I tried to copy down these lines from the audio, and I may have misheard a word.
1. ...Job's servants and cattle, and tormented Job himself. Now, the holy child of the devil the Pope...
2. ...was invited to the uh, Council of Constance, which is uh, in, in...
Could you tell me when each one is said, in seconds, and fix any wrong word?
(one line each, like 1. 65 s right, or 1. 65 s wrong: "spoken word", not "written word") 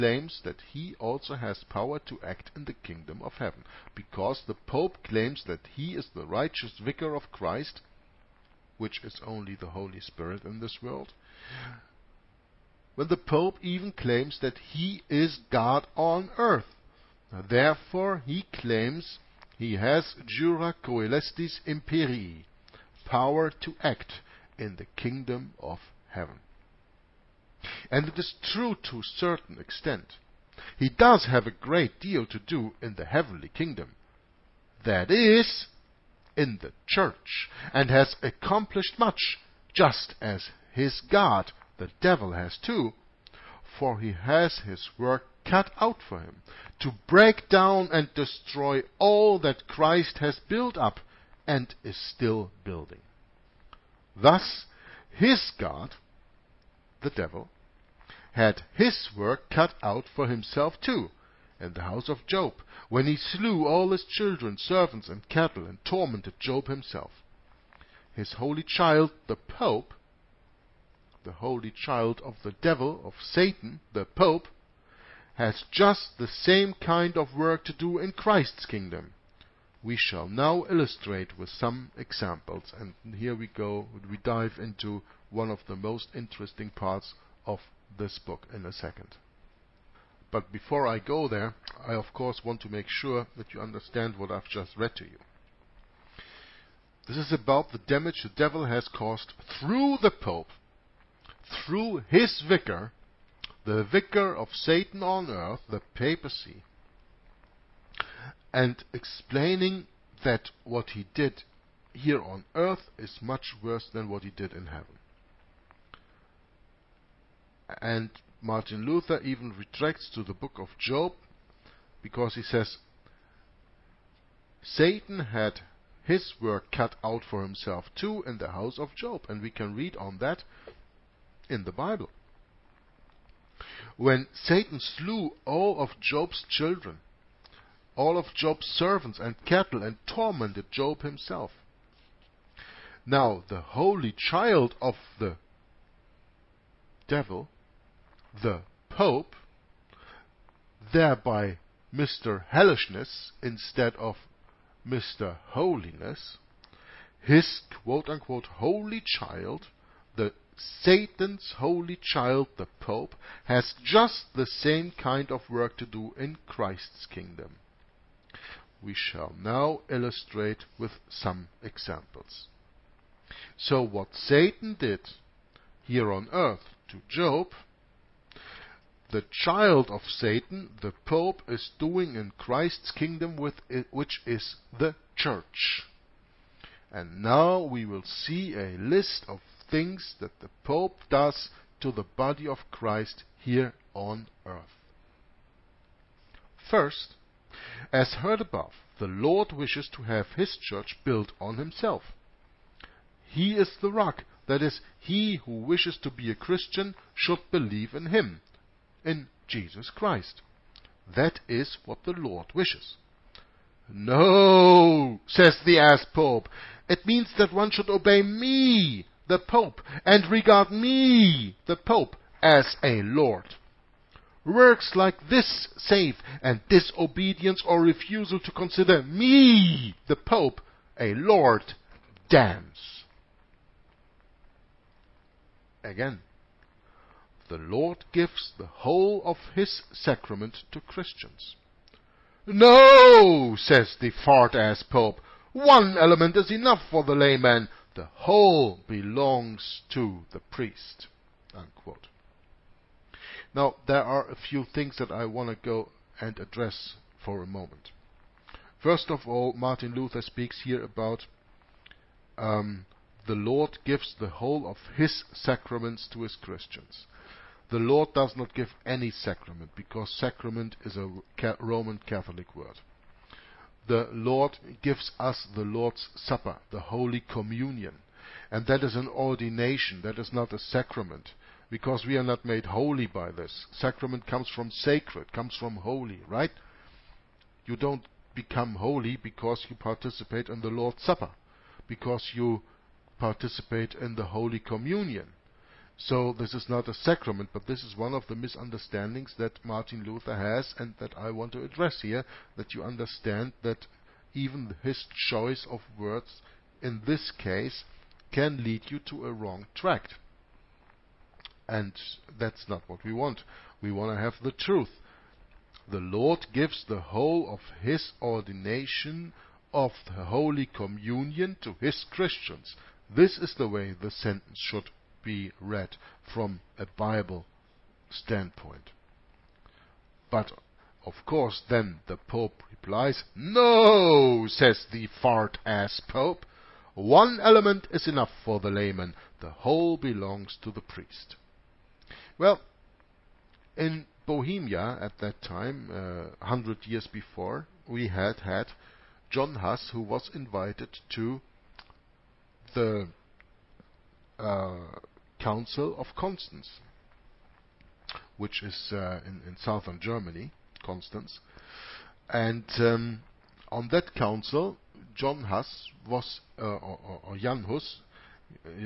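1. 138 s right
2. 350 s right.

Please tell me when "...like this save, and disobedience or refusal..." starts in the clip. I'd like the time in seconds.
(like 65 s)
224 s.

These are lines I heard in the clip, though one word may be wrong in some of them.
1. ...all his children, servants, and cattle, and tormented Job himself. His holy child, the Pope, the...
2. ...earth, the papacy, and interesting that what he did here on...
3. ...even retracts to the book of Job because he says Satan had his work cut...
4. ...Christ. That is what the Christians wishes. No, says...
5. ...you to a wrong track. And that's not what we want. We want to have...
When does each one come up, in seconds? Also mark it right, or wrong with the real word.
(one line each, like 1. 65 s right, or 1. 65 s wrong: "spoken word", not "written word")
1. 63 s right
2. 105 s wrong: "explaining", not "interesting"
3. 119 s right
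4. 209 s wrong: "Lord", not "Christians"
5. 308 s right.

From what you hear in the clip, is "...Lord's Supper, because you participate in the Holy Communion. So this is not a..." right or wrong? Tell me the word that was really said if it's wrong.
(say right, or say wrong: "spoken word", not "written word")
right.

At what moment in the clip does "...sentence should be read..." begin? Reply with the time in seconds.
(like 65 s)
324 s.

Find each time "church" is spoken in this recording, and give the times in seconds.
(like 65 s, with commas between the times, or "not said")
36 s, 185 s, 200 s.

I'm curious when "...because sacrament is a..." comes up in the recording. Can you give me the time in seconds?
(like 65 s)
269 s.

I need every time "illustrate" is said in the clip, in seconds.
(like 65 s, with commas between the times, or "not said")
80 s, 169 s.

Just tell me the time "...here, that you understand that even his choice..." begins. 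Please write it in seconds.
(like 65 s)
302 s.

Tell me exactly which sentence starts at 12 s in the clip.
When the Pope even claims that he is God on earth.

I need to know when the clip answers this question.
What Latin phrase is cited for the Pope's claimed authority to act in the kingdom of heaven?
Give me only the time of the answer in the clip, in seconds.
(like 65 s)
20 s.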